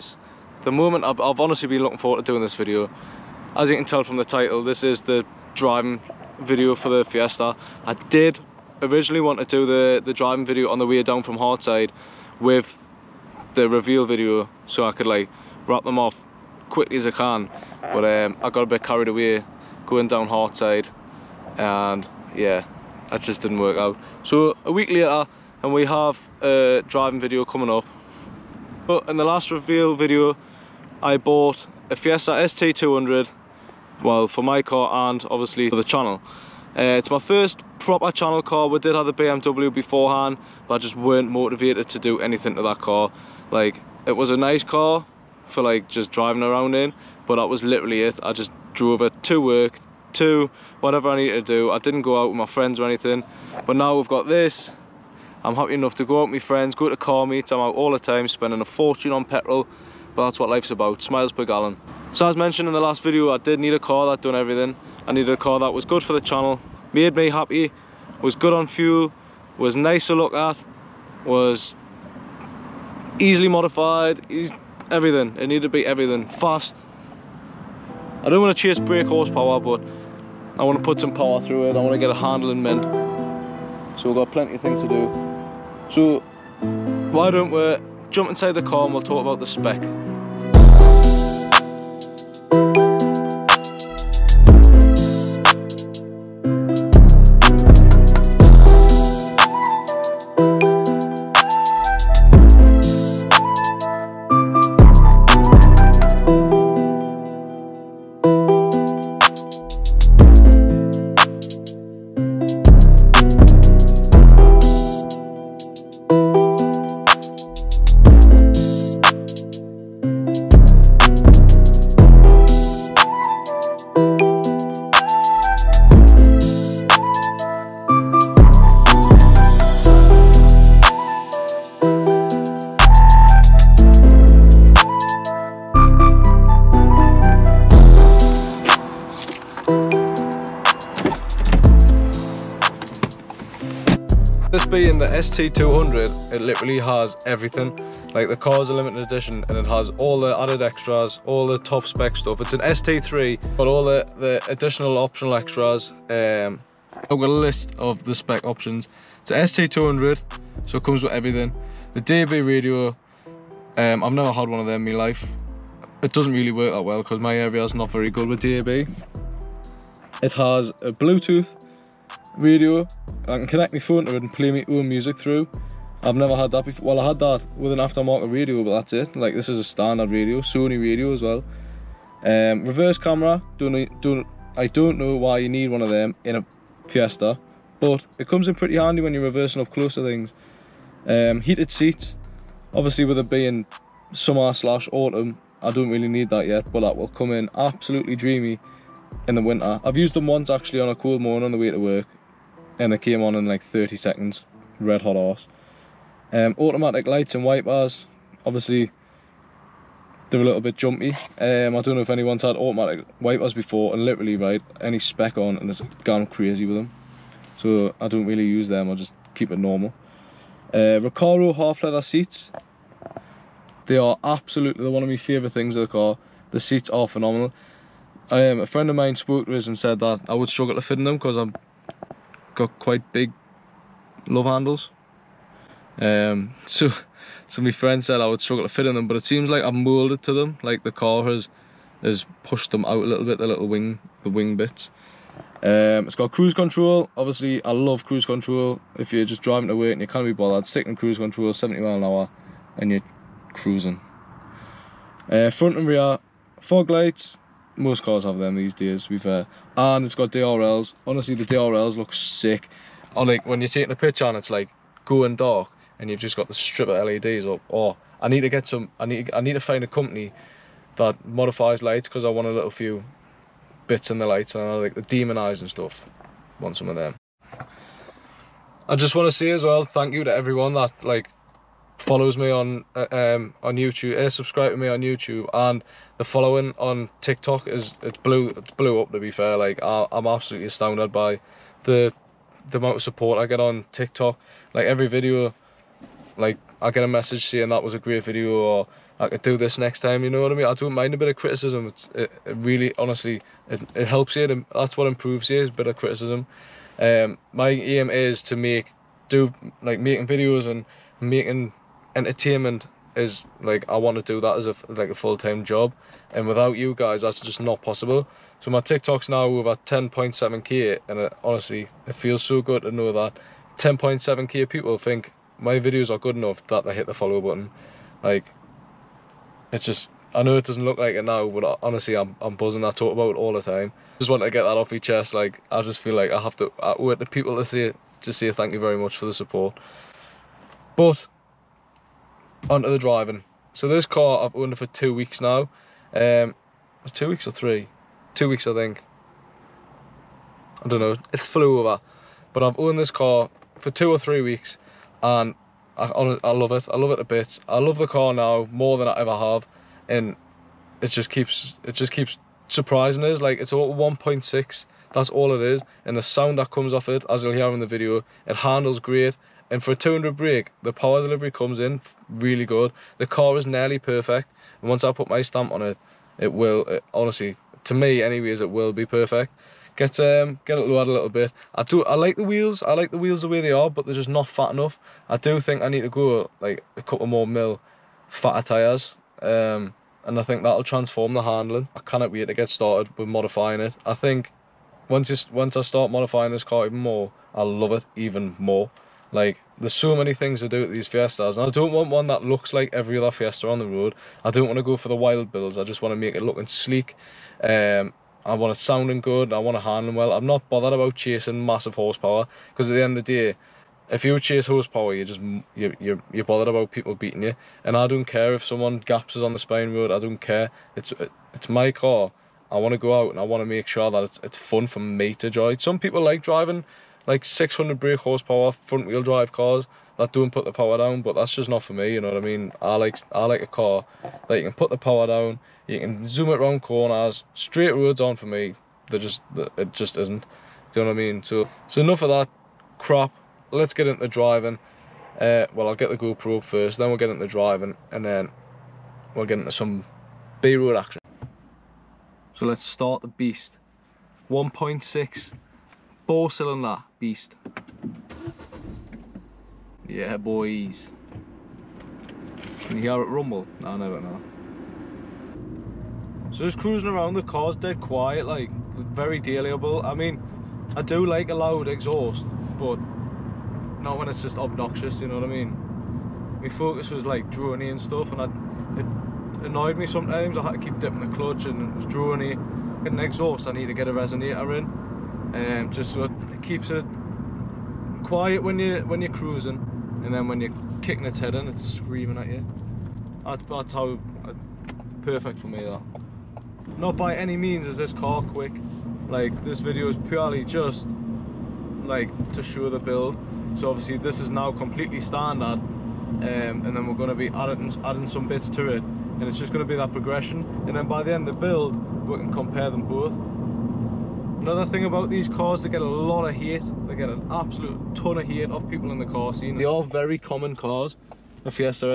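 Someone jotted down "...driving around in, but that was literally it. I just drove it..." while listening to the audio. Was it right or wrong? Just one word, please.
right.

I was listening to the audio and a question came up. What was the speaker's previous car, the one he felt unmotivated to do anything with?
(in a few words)
BMW.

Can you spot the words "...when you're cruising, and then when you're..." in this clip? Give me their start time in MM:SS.
08:09.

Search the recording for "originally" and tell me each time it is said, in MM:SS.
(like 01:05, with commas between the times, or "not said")
00:08.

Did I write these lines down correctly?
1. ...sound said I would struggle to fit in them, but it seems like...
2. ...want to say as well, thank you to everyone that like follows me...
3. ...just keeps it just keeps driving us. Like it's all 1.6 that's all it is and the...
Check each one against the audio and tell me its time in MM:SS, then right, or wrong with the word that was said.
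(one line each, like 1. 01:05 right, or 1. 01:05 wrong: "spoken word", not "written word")
1. 03:57 wrong: "friend", not "sound"
2. 04:39 right
3. 06:01 wrong: "surprising", not "driving".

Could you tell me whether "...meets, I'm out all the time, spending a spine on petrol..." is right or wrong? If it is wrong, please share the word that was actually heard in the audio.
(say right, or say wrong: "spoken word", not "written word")
wrong: "fortune", not "spine".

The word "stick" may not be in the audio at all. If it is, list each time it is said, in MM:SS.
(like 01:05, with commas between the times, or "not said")
04:10.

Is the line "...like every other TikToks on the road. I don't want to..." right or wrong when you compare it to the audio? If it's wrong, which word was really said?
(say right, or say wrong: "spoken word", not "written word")
wrong: "Fiesta", not "TikToks".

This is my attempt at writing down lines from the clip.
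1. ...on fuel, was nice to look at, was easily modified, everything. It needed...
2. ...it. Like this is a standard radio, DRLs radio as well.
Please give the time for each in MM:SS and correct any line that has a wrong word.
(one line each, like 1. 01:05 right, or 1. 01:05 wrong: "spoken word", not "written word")
1. 01:08 right
2. 02:58 wrong: "Sony", not "DRLs".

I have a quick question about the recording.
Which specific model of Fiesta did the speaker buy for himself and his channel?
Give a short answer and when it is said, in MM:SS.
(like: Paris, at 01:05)
ST200, at 00:31.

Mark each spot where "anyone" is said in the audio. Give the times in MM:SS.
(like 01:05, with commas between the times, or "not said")
03:32.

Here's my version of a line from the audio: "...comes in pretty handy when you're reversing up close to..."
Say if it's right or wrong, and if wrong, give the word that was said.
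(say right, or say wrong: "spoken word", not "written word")
right.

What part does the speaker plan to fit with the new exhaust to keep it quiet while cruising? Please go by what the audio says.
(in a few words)
resonator.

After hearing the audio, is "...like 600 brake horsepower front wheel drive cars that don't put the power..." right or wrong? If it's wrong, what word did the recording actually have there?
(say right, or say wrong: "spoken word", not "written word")
right.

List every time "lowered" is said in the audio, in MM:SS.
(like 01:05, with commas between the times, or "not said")
06:20.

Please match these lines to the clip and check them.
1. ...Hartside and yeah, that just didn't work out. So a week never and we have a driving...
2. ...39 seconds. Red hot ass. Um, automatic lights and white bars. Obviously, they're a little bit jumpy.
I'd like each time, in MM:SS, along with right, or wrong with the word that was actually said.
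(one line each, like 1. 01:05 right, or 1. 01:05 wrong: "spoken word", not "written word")
1. 00:20 wrong: "later", not "never"
2. 03:23 wrong: "30", not "39".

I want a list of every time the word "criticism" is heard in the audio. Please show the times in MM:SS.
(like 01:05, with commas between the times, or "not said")
05:01, 05:05.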